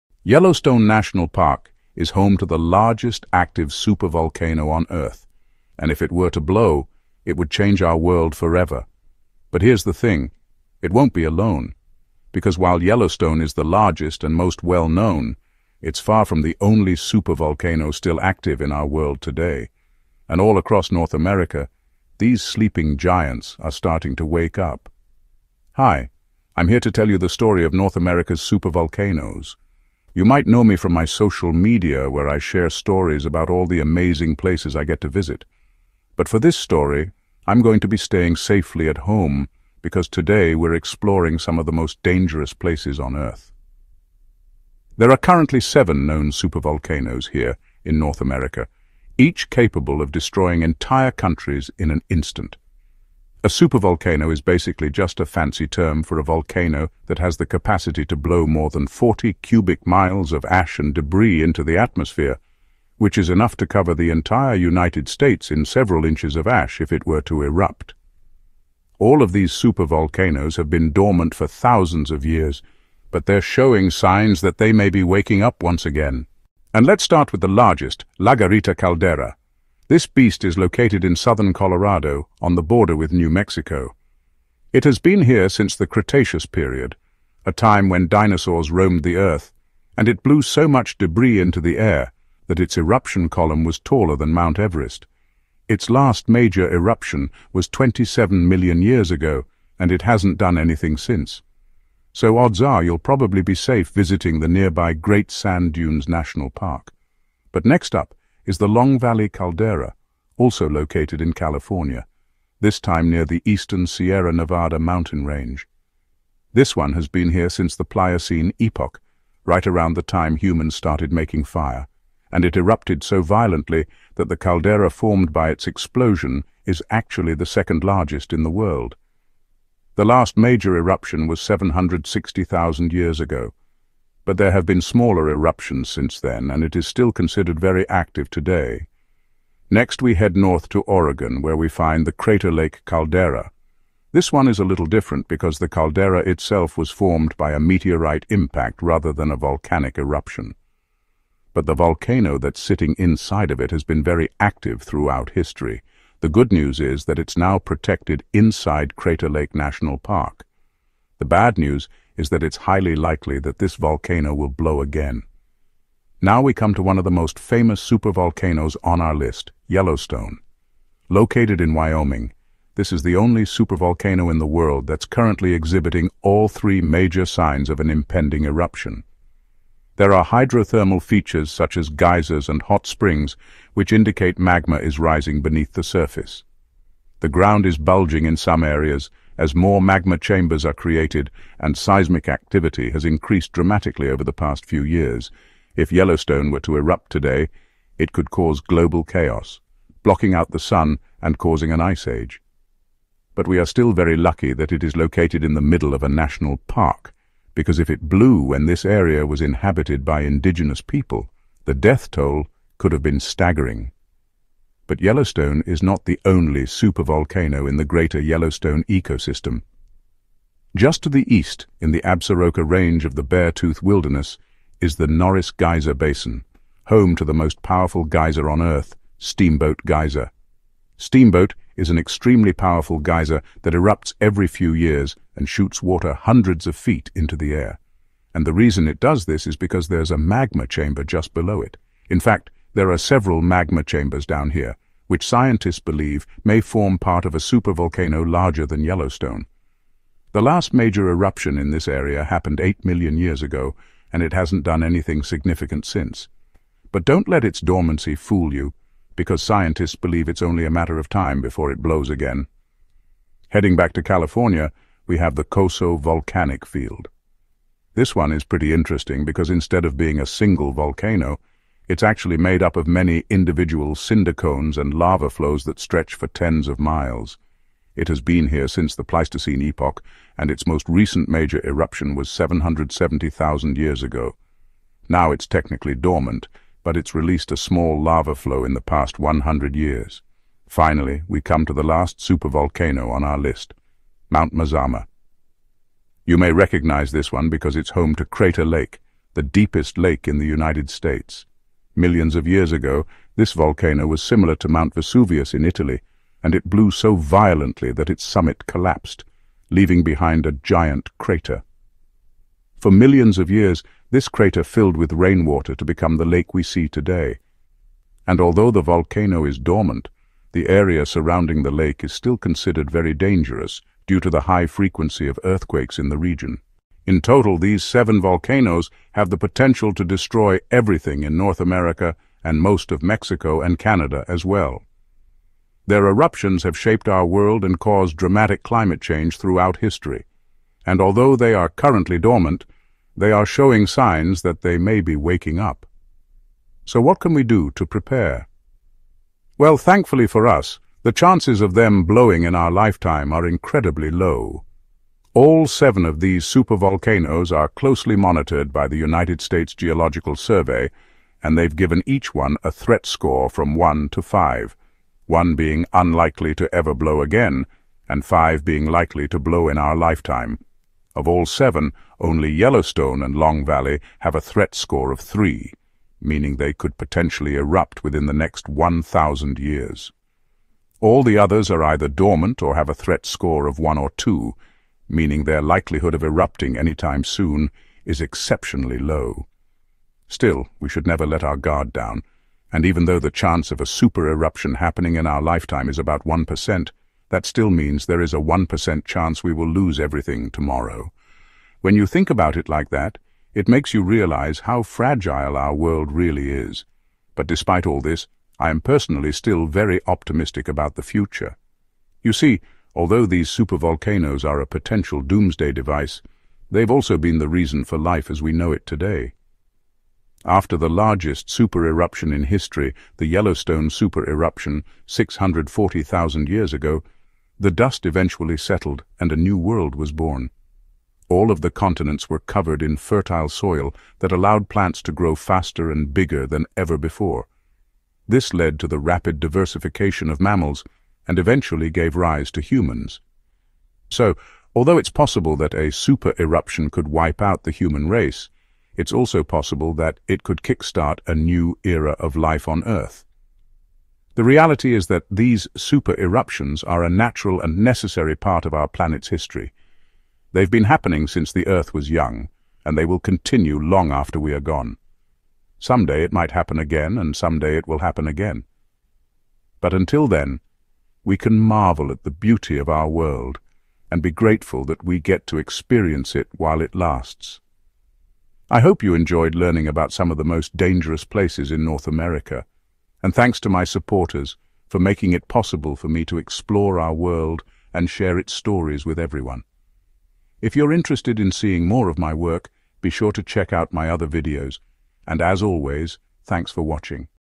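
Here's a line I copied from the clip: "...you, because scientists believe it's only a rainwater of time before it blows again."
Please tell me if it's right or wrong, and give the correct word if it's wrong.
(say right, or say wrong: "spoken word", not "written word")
wrong: "matter", not "rainwater".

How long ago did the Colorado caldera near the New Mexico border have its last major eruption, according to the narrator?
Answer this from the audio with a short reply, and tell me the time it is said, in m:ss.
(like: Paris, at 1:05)
27 million years ago, at 1:37.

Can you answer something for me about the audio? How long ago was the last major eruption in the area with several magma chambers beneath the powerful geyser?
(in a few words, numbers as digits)
8 million years ago.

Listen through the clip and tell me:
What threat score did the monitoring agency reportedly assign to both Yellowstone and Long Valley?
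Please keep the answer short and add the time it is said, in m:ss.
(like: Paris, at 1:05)
3, at 6:15.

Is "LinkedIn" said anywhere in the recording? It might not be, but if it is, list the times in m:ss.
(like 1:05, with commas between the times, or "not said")
not said.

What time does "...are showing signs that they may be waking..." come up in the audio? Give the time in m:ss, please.
5:43.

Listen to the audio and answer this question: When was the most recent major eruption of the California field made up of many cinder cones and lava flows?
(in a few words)
770,000 years ago.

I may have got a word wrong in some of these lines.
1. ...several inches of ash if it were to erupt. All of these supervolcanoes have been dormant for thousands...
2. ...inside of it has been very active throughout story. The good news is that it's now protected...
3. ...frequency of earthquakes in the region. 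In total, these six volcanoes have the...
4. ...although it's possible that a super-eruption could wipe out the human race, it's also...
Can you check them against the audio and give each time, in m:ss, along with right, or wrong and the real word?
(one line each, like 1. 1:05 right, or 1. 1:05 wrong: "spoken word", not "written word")
1. 1:05 right
2. 2:32 wrong: "history", not "story"
3. 5:24 wrong: "seven", not "six"
4. 7:24 right.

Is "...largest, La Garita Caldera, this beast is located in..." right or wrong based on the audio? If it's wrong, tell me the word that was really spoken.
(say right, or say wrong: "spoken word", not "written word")
right.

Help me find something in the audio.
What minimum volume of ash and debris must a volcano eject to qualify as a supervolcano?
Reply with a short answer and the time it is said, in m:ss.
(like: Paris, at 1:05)
40 cubic miles, at 0:58.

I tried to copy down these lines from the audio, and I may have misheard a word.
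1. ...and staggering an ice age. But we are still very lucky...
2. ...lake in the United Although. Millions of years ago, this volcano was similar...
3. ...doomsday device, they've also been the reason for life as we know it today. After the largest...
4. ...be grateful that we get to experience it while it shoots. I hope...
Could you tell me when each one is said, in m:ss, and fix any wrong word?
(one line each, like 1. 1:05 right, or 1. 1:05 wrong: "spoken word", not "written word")
1. 3:21 wrong: "causing", not "staggering"
2. 4:59 wrong: "States", not "Although"
3. 6:55 right
4. 7:54 wrong: "lasts", not "shoots".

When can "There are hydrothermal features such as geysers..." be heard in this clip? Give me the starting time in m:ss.
2:59.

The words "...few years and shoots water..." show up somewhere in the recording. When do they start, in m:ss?
3:54.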